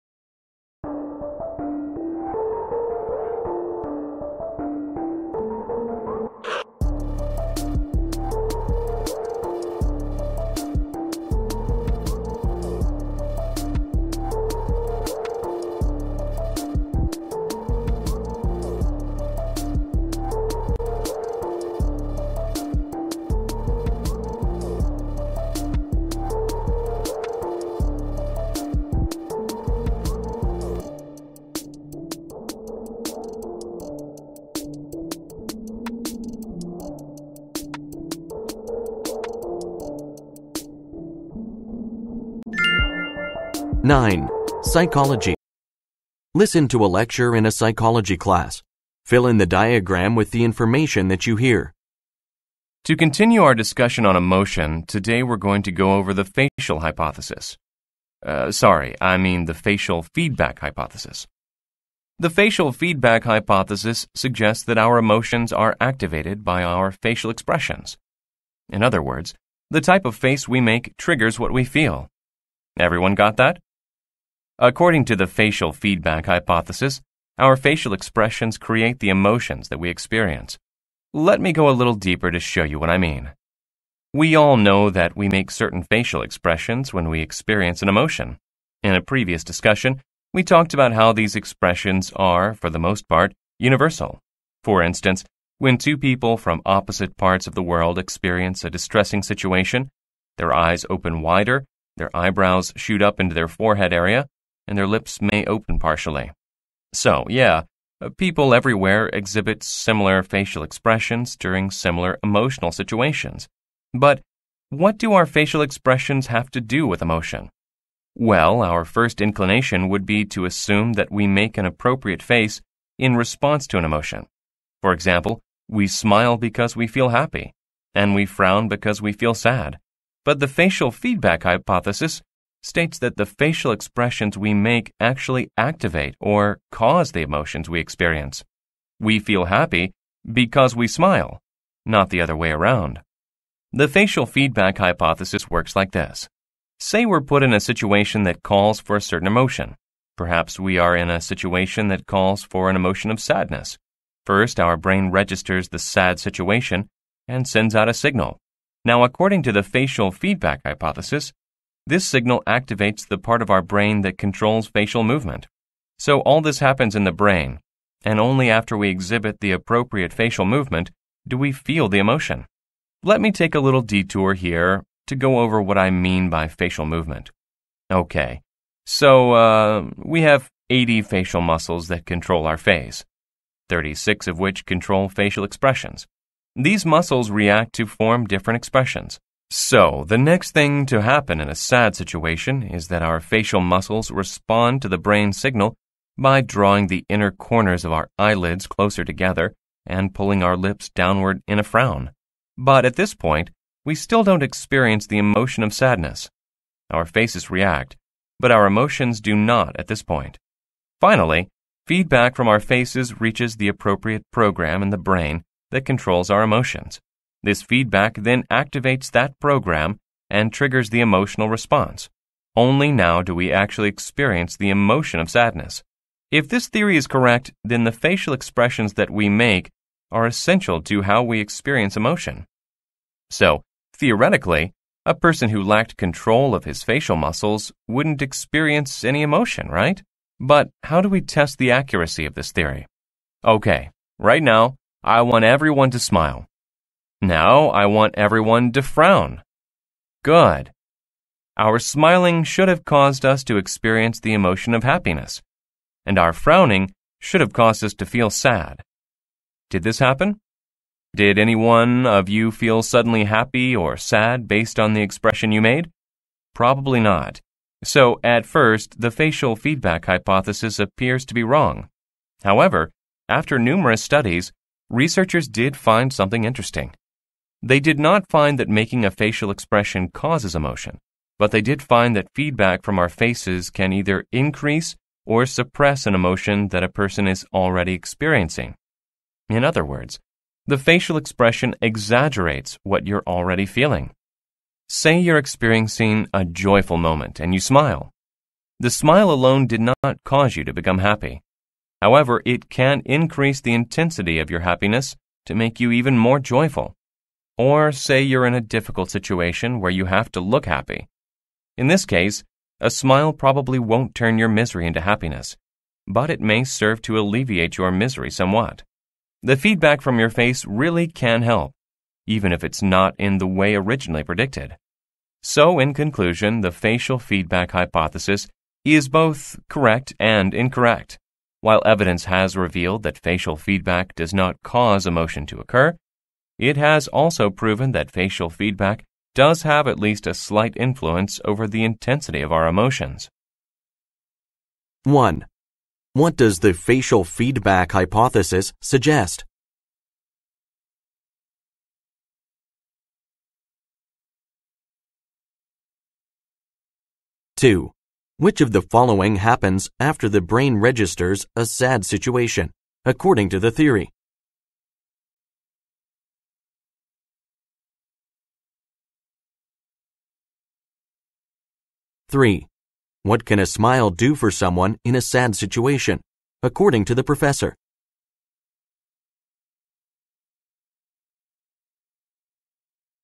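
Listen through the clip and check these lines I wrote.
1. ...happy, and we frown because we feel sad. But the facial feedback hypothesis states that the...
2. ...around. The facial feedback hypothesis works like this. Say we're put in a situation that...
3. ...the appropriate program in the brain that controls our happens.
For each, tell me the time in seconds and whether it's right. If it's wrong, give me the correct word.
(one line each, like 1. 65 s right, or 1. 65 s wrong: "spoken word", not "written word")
1. 127 s right
2. 142 s right
3. 213 s wrong: "emotions", not "happens".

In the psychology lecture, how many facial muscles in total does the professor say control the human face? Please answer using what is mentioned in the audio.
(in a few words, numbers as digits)
80.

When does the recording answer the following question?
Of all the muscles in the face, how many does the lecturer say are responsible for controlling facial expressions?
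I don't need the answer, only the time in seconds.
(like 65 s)
183 s.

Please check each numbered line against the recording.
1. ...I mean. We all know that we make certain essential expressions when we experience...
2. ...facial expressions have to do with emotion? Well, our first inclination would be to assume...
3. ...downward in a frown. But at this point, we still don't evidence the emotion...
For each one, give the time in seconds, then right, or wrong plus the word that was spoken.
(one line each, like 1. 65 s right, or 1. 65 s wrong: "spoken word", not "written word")
1. 82 s wrong: "facial", not "essential"
2. 115 s right
3. 200 s wrong: "experience", not "evidence".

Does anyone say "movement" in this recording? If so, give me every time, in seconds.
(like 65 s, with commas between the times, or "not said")
165 s, 170 s, 176 s.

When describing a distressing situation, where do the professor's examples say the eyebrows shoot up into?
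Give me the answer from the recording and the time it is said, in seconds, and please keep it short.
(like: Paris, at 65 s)
forehead area, at 103 s.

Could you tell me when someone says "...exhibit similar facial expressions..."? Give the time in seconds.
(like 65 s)
109 s.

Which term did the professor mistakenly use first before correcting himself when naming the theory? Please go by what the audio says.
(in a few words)
facial hypothesis.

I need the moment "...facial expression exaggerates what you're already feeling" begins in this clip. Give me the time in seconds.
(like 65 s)
290 s.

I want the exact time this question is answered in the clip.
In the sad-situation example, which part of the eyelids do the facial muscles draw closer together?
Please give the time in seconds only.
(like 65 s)
197 s.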